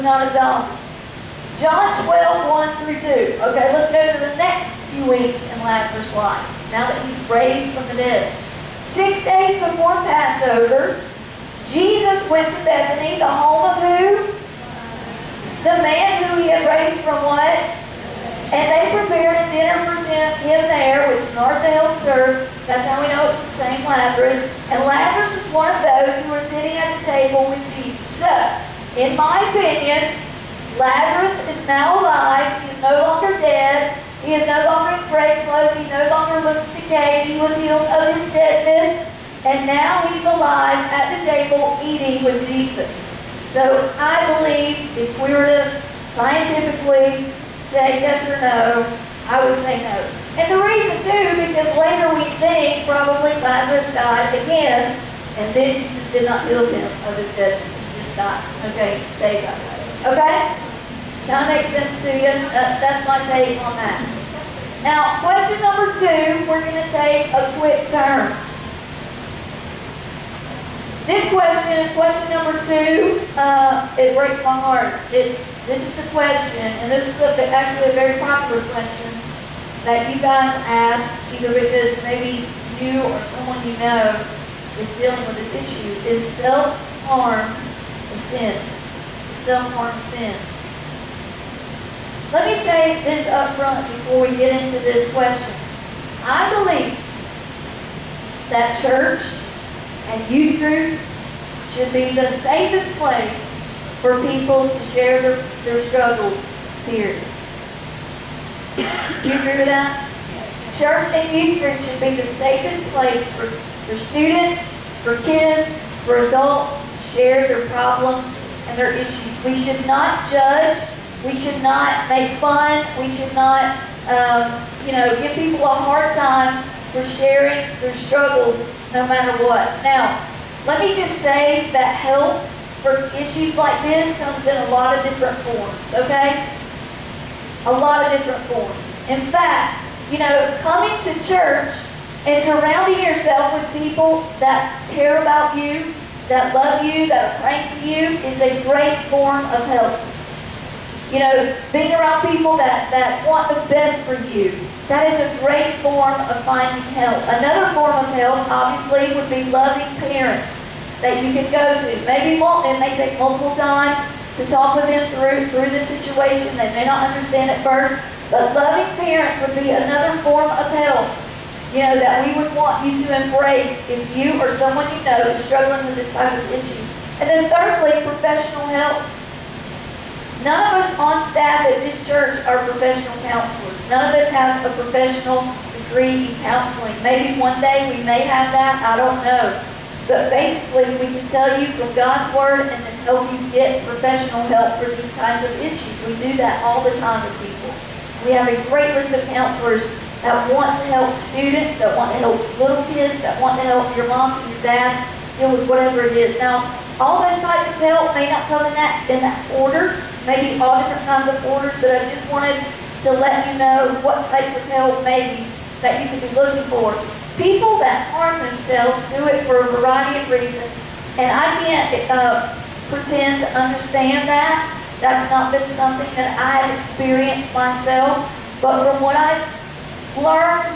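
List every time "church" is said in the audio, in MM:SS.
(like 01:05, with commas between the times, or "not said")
01:38, 01:50, 02:21, 03:02.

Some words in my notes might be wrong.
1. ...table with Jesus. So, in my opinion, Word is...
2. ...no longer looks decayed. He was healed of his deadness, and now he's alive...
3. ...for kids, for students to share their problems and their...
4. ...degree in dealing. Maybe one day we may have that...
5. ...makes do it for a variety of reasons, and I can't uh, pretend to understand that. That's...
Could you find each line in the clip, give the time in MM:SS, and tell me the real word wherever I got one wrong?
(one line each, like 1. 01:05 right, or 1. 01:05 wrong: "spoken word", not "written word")
1. 00:27 wrong: "Lazarus", not "Word"
2. 00:35 right
3. 01:55 wrong: "adults", not "students"
4. 03:05 wrong: "counseling", not "dealing"
5. 03:38 wrong: "themselves", not "makes".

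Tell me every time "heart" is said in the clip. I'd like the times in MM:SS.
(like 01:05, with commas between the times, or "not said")
01:14.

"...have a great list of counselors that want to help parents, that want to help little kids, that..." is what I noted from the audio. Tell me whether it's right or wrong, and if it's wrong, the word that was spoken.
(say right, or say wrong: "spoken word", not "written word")
wrong: "students", not "parents".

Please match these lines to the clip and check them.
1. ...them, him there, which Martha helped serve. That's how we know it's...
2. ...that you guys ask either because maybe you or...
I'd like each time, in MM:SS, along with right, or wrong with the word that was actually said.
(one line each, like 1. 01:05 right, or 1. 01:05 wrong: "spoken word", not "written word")
1. 00:20 right
2. 01:19 right.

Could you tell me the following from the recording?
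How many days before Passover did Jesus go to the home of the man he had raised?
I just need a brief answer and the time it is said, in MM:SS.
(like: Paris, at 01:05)
6, at 00:08.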